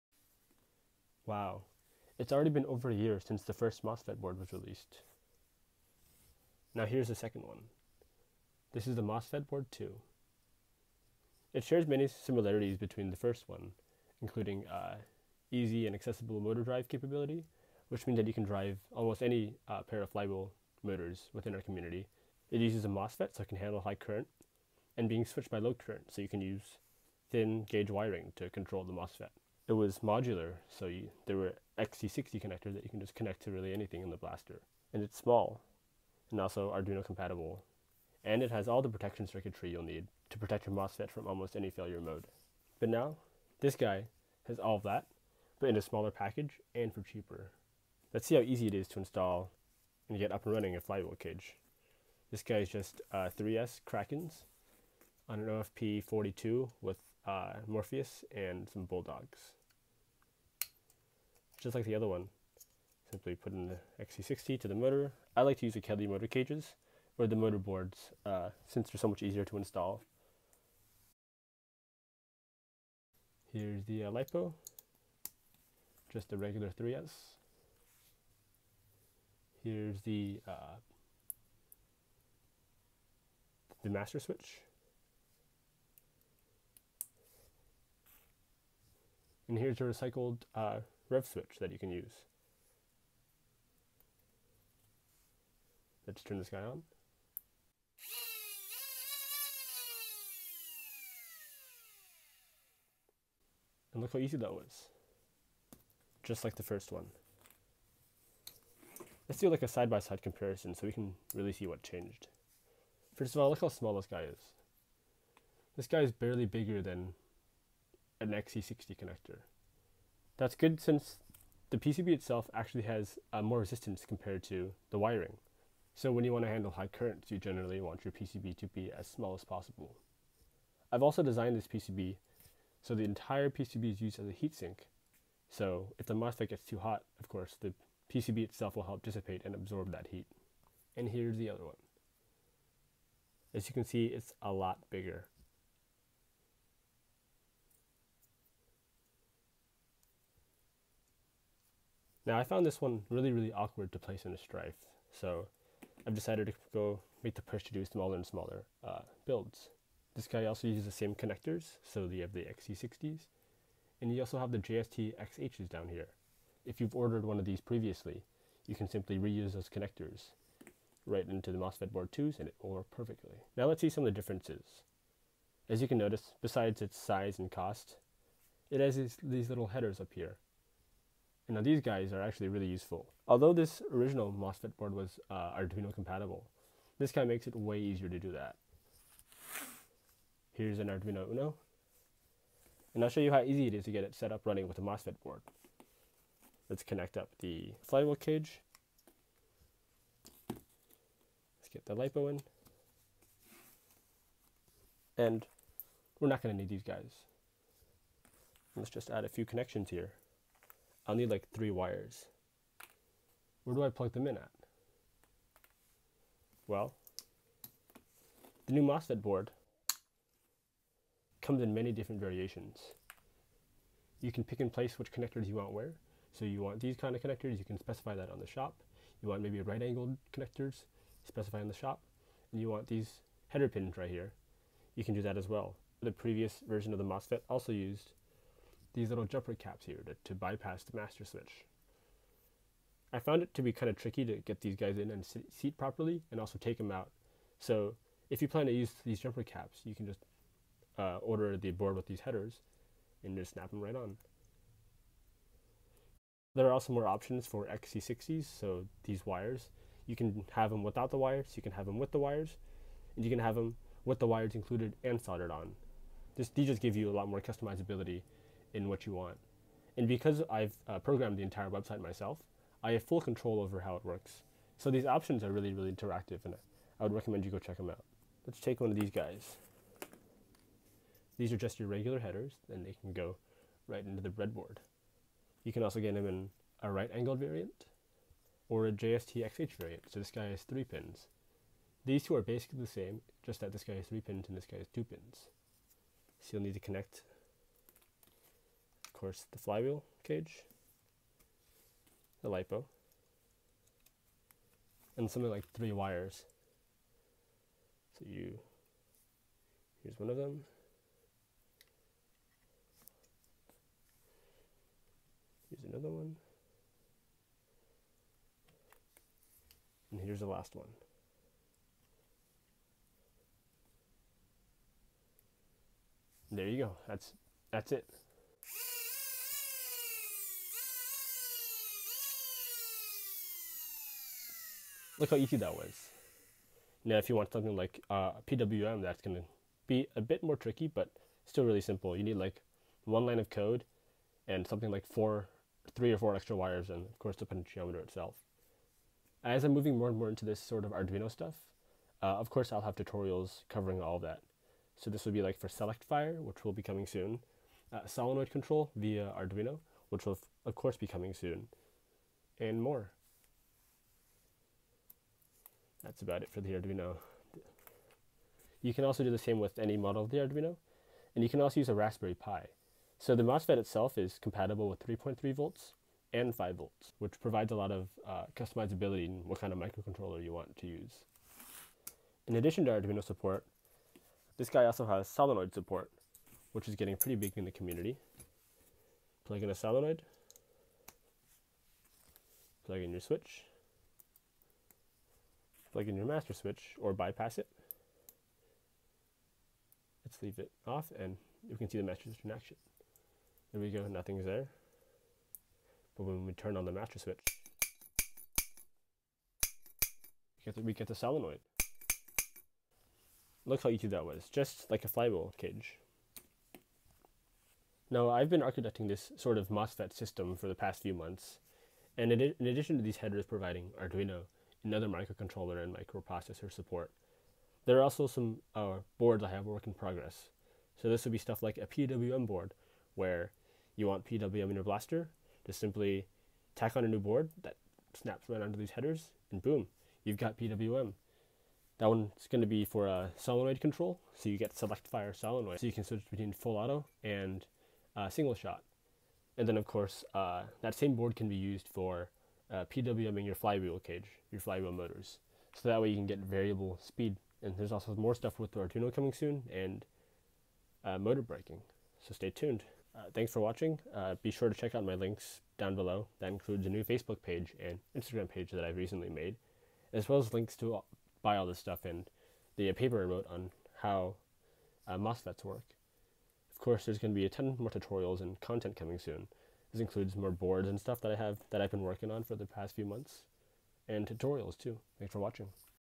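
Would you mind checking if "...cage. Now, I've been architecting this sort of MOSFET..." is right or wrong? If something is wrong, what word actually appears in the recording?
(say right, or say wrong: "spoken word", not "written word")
right.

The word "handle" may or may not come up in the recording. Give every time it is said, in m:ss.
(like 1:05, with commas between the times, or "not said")
0:23, 2:06.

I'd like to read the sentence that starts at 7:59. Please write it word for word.
This includes more boards and stuff that I have that I've been working on for the past few months and tutorials too.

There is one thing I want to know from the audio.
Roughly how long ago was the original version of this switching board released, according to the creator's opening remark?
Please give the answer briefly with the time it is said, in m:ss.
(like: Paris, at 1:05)
over a year, at 0:02.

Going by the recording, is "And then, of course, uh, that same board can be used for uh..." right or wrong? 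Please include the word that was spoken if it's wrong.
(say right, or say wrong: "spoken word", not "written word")
right.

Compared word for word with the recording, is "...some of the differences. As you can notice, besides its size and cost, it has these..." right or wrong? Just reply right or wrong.
right.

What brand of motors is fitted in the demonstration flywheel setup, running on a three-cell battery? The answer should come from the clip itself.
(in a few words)
Krakens.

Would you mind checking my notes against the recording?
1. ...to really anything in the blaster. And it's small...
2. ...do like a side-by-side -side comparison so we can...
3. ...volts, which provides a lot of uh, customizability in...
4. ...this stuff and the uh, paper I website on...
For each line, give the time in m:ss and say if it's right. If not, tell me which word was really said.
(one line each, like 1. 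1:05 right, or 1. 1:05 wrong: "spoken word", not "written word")
1. 0:33 right
2. 1:49 right
3. 6:16 right
4. 7:51 wrong: "wrote", not "website".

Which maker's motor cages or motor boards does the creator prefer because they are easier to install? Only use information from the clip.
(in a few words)
Kelly.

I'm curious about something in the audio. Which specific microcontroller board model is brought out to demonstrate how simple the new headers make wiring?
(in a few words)
Arduino Uno.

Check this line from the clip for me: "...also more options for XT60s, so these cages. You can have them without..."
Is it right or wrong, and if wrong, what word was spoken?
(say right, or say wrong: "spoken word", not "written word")
wrong: "wires", not "cages".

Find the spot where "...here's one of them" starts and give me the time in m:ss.
5:10.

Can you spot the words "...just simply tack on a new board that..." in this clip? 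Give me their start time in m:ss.
7:15.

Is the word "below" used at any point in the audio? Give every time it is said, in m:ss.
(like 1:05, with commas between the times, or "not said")
7:45.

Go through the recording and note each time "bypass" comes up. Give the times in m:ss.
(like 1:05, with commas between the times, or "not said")
4:00, 6:37.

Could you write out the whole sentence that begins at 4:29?
And because I've uh, programmed the entire website myself, I have full control over how it works.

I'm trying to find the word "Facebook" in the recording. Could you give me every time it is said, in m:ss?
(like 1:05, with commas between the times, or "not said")
7:47.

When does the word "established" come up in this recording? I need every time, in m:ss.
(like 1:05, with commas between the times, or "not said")
not said.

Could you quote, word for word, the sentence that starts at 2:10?
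I've also designed this PCB so the entire PCB is used as a heatsink.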